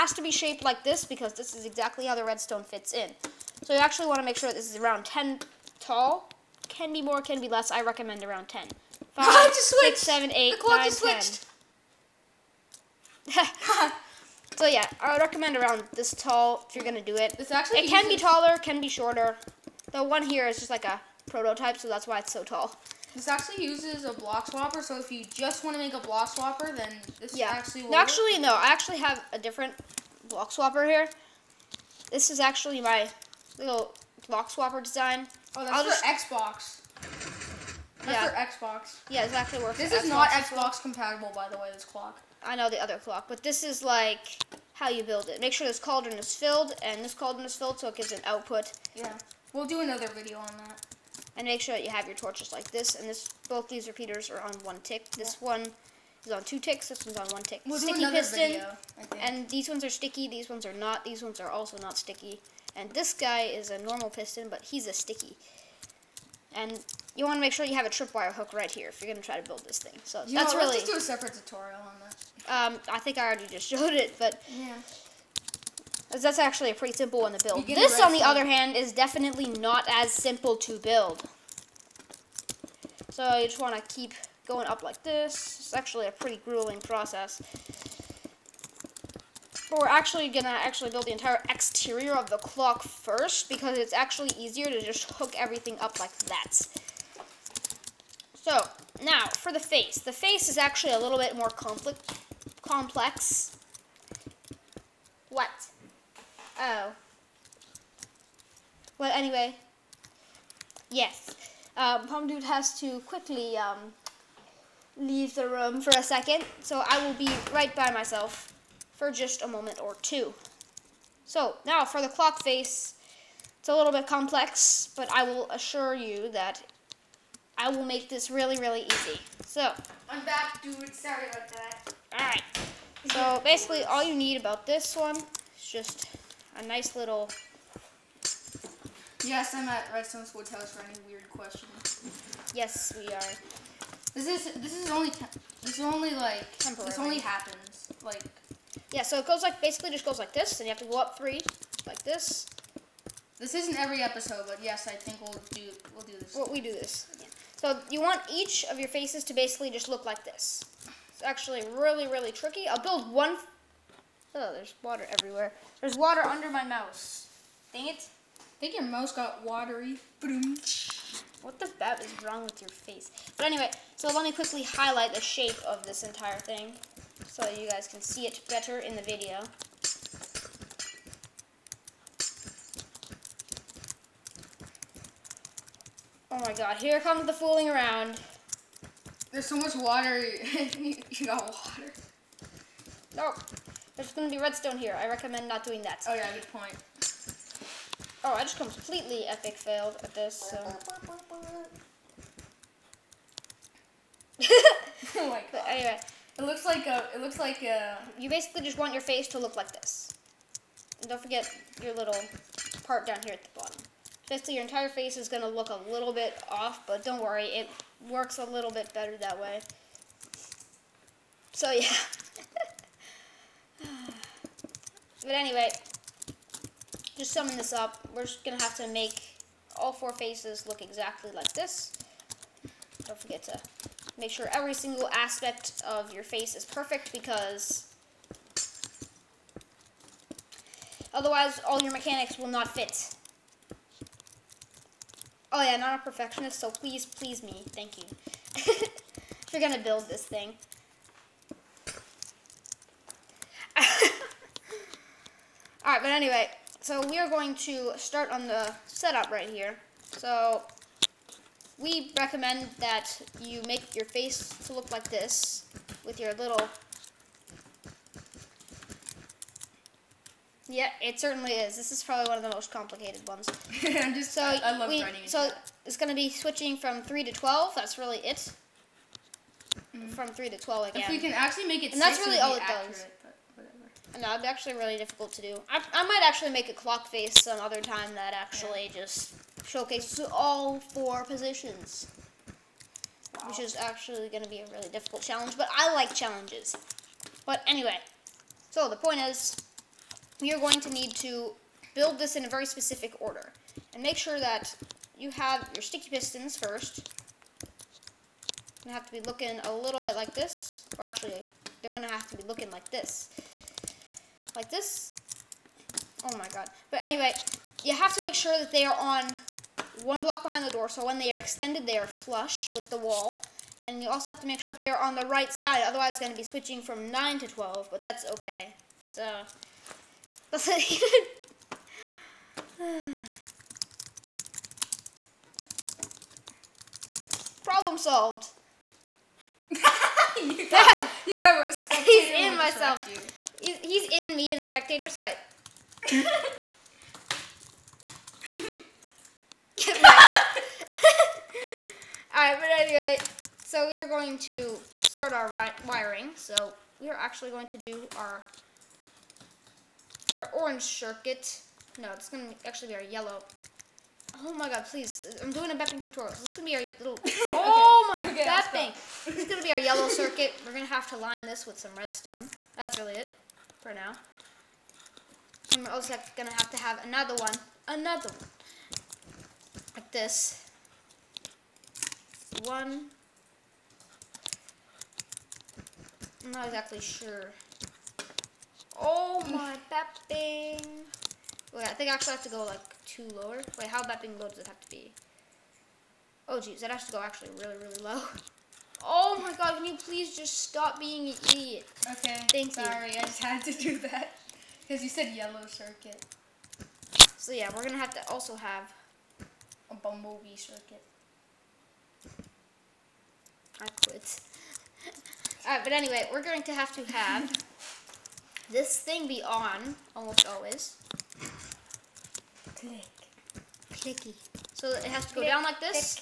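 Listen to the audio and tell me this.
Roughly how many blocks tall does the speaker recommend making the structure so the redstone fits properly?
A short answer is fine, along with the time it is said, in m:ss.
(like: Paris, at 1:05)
10, at 0:04.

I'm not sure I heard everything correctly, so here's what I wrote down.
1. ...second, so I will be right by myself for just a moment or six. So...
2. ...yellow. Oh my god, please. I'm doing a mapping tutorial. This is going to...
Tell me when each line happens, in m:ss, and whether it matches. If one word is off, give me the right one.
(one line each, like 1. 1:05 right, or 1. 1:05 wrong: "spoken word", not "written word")
1. 1:56 wrong: "two", not "six"
2. 6:03 right.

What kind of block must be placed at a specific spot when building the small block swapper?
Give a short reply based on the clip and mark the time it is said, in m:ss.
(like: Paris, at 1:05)
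Tripwire hook, at 1:07.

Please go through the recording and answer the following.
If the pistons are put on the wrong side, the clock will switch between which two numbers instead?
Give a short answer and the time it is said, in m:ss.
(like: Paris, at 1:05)
9 to 12, at 5:27.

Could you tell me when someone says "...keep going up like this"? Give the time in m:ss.
1:23.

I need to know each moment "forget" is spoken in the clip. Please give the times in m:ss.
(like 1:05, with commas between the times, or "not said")
3:31, 3:53.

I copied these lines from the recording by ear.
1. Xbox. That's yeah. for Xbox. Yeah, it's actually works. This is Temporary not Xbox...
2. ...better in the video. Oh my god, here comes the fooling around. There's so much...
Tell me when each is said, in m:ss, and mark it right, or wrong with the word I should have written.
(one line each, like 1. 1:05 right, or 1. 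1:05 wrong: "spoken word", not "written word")
1. 0:36 wrong: "Xbox", not "Temporary"
2. 2:58 right.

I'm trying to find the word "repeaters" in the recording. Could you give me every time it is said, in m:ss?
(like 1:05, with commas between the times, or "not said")
0:53.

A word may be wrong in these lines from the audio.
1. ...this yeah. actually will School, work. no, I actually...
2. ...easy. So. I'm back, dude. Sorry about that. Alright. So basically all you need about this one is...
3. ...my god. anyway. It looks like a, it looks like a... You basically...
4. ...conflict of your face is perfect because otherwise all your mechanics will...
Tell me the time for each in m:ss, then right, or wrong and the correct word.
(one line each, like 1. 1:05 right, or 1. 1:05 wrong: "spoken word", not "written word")
1. 0:27 wrong: "Actually", not "School"
2. 2:08 right
3. 3:25 right
4. 3:55 wrong: "aspect", not "conflict".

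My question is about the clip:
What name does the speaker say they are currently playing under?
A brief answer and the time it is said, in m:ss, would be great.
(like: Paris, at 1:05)
Redstone School House, at 2:19.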